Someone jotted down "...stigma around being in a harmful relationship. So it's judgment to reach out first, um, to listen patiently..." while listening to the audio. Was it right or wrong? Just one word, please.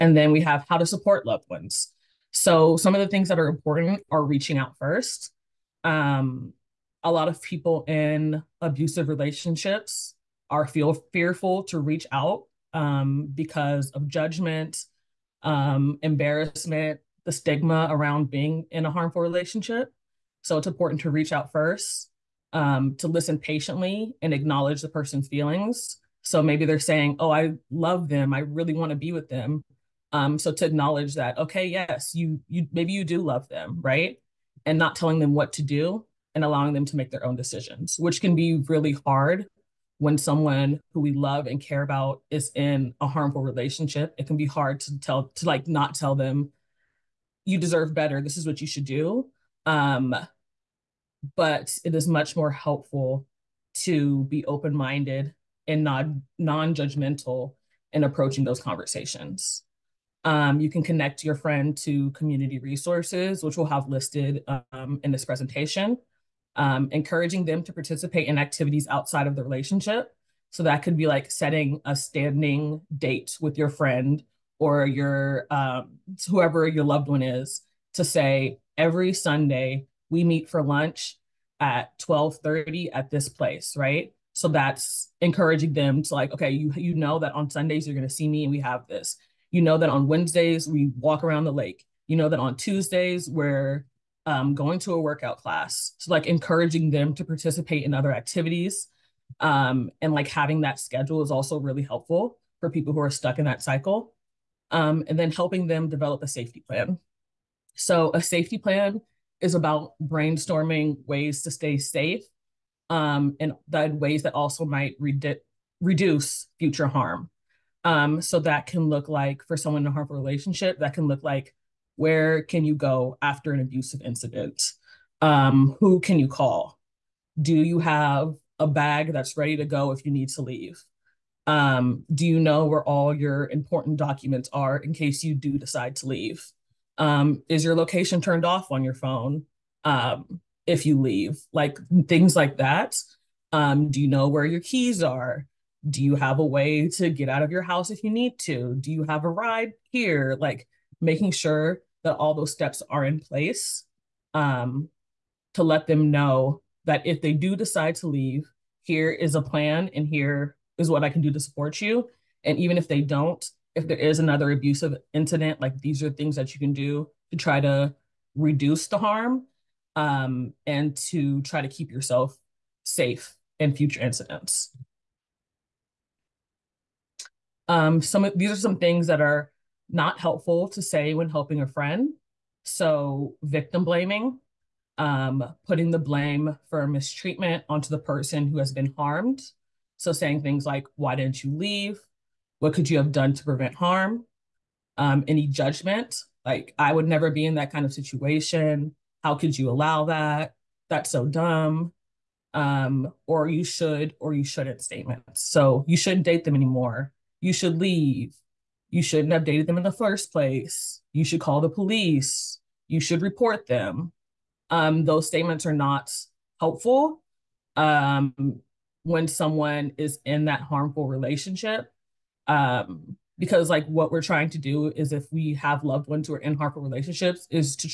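wrong.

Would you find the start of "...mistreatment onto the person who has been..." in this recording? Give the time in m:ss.
3:06.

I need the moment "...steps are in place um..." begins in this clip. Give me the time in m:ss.
2:32.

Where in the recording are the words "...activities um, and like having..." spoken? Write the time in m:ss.
1:38.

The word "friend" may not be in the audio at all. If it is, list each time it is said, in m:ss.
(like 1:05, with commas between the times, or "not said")
1:01, 1:13, 3:01.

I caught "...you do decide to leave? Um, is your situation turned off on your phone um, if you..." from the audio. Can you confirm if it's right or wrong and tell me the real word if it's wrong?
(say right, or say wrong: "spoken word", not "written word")
wrong: "location", not "situation".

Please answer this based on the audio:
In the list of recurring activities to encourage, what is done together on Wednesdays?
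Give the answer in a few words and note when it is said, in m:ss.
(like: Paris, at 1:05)
walk around the lake, at 1:30.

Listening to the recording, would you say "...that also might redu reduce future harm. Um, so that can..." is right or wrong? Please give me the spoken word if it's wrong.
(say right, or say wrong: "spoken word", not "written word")
right.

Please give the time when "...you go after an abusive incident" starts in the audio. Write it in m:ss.
2:02.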